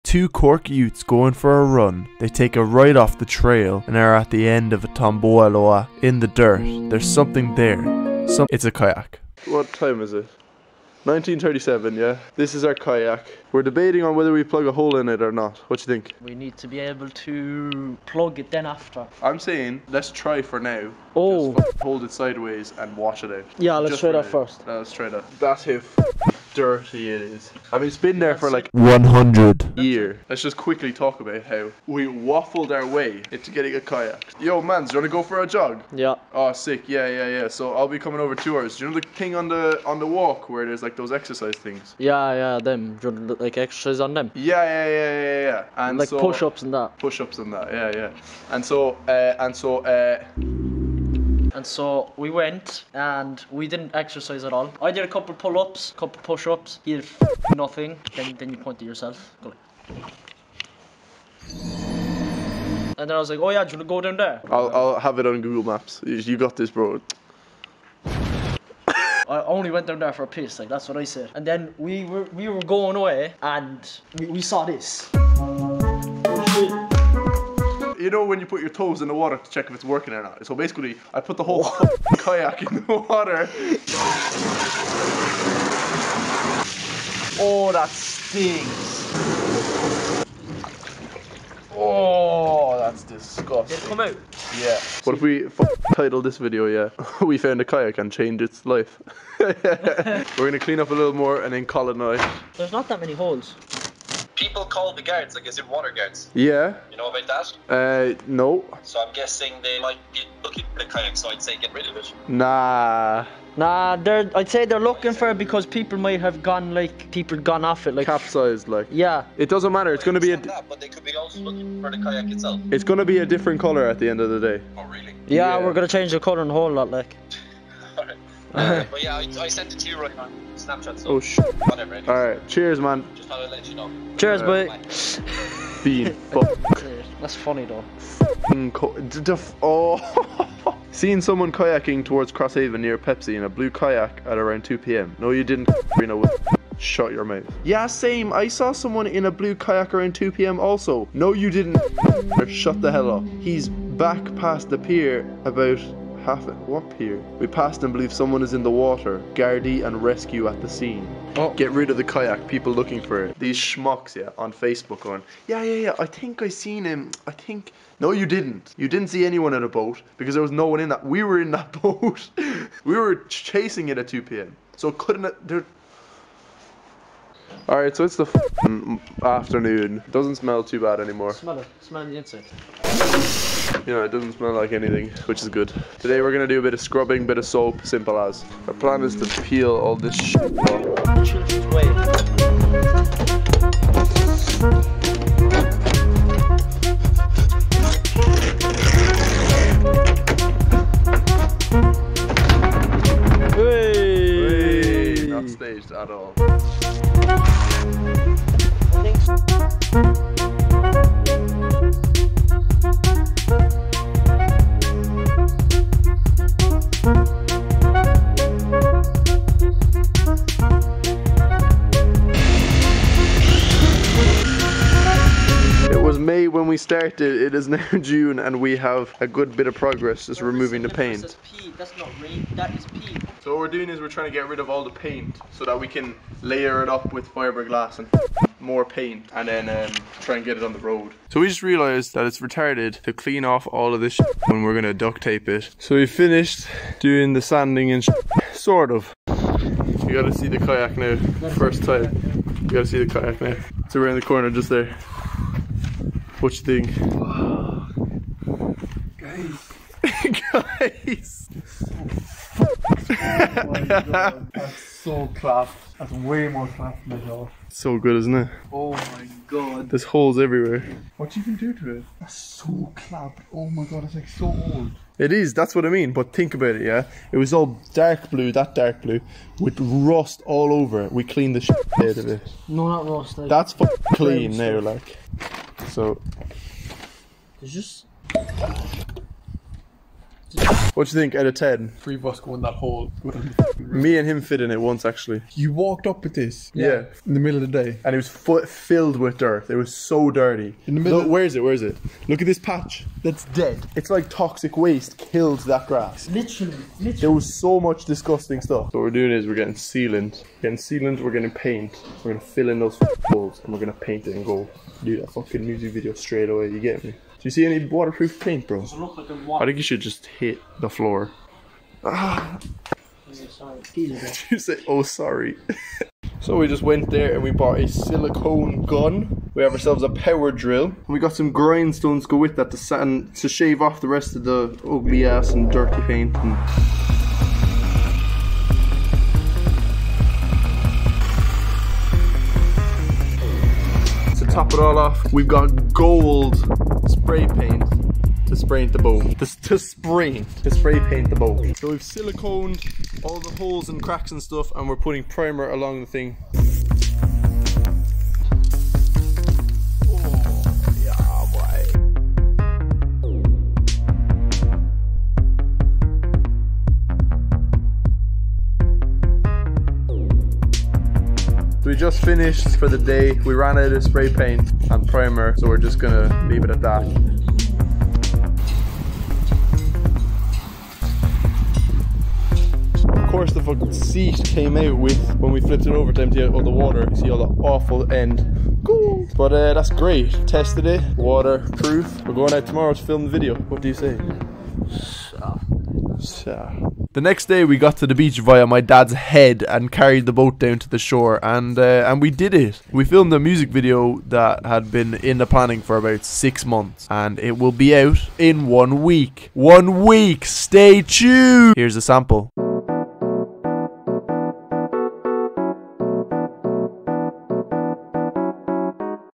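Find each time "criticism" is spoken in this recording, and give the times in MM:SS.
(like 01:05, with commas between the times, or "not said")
not said.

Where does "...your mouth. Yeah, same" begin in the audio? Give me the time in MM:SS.
02:27.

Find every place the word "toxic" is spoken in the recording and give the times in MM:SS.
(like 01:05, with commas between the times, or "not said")
05:04.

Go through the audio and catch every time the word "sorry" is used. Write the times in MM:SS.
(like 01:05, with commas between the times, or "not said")
05:25.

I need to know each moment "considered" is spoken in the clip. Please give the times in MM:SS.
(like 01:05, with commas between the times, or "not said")
not said.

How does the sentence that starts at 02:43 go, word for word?
These schmucks, yeah, on Facebook on.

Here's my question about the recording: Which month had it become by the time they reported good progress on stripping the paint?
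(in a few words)
June.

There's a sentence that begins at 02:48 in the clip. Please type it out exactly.
You didn't see anyone in a boat because there was no one in that.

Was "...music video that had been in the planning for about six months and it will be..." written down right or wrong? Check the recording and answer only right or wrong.
right.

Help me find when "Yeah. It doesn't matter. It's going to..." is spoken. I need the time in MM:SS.
01:58.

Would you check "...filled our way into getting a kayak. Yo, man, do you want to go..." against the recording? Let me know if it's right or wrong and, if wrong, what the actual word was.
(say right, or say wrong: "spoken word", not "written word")
wrong: "waffled", not "filled".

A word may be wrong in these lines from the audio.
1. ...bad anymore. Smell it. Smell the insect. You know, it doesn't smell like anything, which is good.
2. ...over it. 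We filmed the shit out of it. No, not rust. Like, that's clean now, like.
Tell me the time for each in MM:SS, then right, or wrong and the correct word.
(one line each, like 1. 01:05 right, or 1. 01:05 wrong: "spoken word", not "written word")
1. 03:00 right
2. 04:40 wrong: "cleaned", not "filmed".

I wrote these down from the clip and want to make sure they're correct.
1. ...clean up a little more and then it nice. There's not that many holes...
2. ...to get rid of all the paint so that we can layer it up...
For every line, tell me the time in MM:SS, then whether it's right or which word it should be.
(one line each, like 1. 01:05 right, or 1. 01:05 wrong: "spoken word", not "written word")
1. 01:40 right
2. 03:54 right.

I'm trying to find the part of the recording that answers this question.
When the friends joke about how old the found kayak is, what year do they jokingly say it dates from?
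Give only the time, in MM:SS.
00:11.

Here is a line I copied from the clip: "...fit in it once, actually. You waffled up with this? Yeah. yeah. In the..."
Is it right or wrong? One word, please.
wrong.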